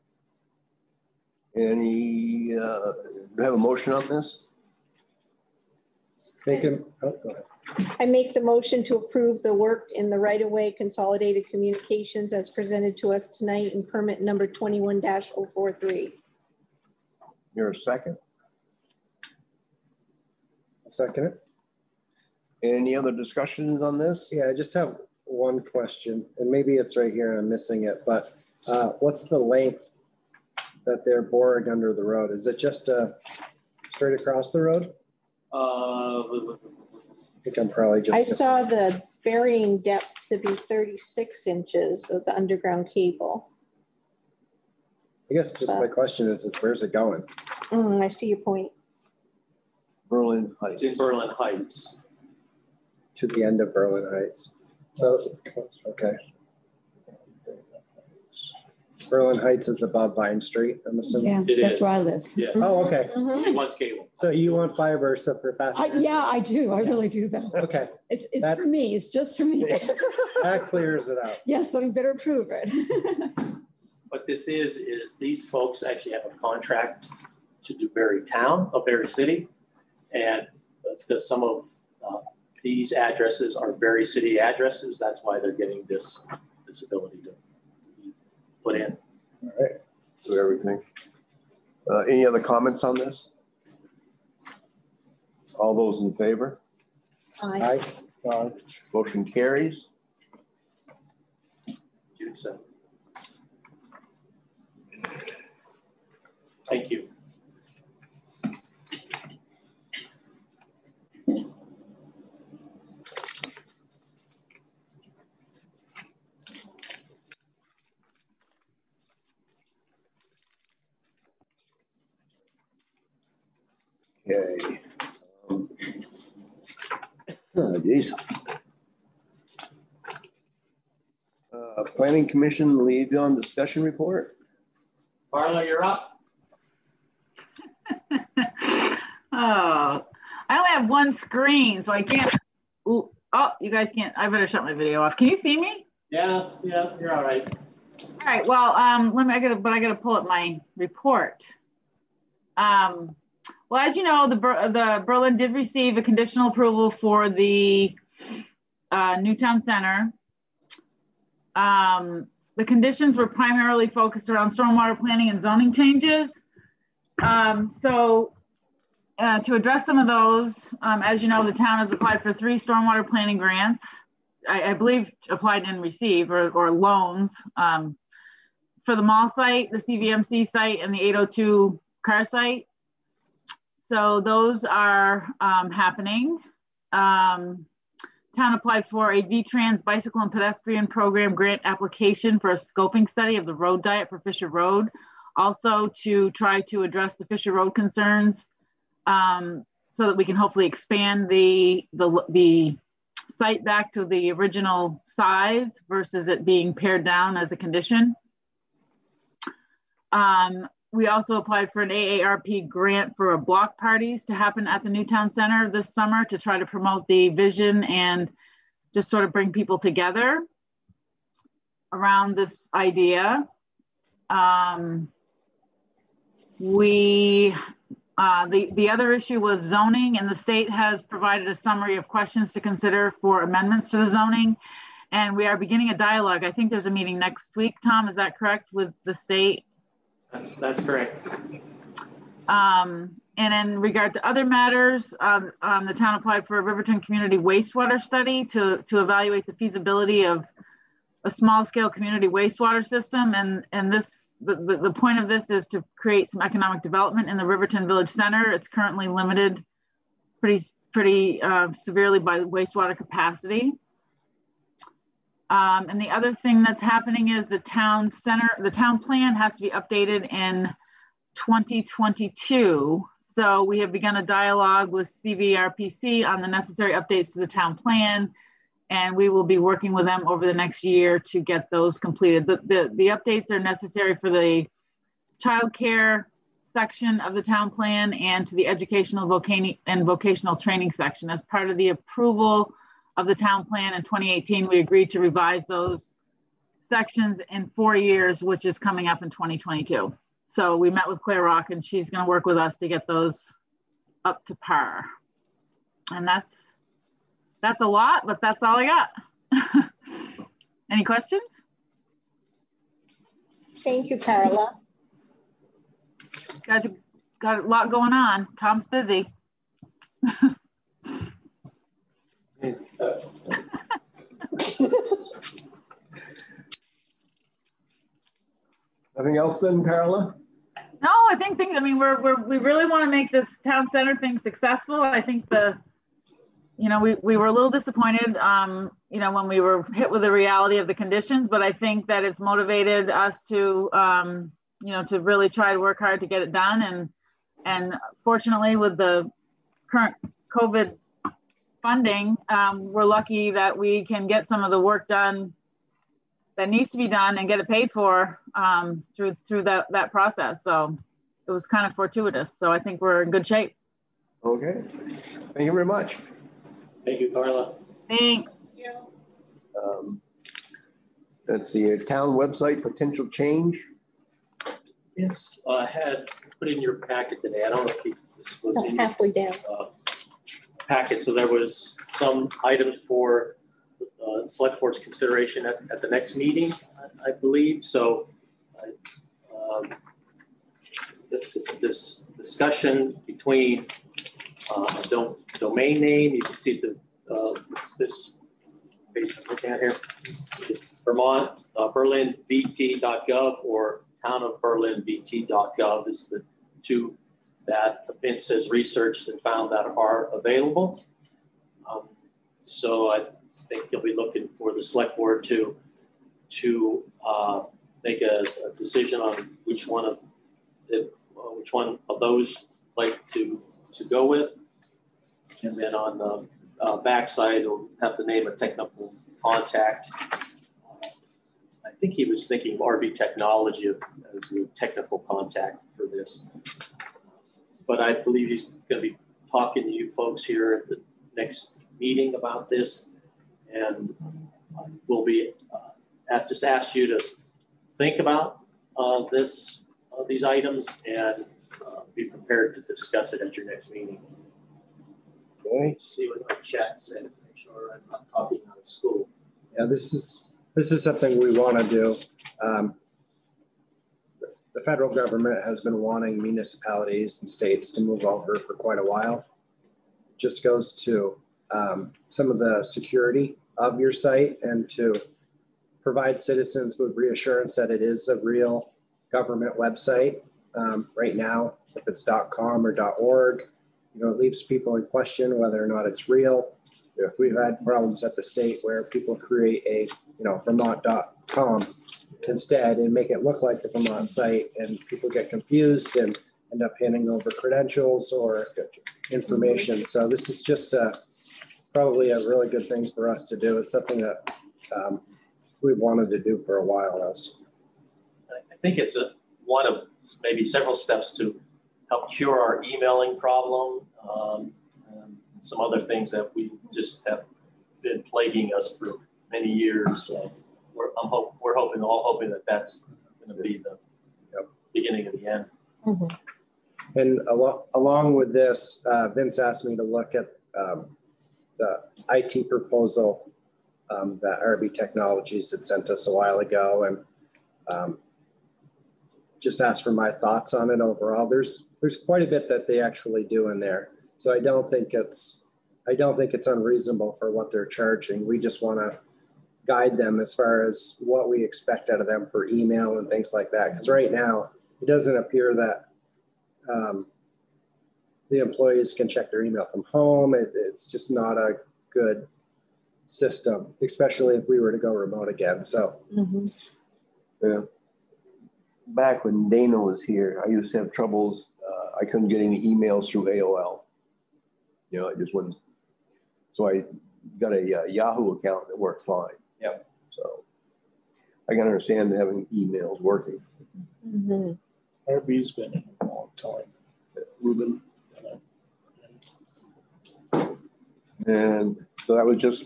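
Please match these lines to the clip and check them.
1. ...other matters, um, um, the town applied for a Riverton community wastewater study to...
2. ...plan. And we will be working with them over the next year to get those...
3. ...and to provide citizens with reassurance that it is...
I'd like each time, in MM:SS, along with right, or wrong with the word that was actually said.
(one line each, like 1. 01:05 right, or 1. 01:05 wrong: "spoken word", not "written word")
1. 04:04 right
2. 04:37 right
3. 07:54 right.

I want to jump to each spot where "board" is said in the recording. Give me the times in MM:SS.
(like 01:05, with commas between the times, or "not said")
06:24, 06:55.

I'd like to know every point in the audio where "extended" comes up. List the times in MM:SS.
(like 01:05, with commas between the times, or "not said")
not said.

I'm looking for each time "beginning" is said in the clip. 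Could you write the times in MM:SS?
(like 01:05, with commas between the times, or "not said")
03:55, 08:44.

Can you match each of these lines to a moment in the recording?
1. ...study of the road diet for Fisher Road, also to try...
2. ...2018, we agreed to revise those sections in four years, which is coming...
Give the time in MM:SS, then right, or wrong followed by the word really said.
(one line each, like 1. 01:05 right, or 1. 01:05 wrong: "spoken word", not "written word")
1. 03:13 right
2. 04:54 right.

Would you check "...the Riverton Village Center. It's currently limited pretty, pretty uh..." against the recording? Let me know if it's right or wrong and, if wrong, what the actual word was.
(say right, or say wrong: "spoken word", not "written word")
right.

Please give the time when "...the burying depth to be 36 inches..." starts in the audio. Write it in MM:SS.
00:38.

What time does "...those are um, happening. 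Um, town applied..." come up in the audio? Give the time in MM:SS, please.
03:04.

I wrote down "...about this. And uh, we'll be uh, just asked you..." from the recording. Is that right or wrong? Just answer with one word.
right.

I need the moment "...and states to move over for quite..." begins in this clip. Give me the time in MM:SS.
07:47.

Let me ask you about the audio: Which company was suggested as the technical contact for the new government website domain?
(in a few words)
RB Technology.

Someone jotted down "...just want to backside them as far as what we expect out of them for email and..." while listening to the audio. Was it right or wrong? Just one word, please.
wrong.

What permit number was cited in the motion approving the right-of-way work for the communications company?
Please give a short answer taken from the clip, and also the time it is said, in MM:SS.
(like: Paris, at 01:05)
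21-043, at 00:14.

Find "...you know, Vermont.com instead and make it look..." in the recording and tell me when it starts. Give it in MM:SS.
08:10.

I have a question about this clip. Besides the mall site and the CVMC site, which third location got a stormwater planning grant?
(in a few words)
802 car site.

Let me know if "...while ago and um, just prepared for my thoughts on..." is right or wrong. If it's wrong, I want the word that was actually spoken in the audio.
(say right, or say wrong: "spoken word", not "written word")
wrong: "asked", not "prepared".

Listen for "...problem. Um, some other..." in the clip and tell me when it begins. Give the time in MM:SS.
08:33.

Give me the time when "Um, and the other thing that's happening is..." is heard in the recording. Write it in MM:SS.
04:25.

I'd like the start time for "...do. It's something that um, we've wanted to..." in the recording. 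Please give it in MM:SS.
08:23.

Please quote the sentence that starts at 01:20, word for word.
And that's because some of uh, these addresses are Barre City addresses.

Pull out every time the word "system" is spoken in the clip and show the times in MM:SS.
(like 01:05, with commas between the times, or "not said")
04:12, 09:23.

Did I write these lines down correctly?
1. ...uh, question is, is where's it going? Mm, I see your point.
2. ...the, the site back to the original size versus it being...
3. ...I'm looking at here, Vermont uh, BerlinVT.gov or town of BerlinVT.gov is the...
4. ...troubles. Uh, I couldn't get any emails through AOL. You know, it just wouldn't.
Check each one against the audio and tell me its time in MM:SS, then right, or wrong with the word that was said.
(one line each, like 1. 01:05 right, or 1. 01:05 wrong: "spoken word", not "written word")
1. 00:45 right
2. 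03:21 right
3. 06:39 right
4. 09:31 right.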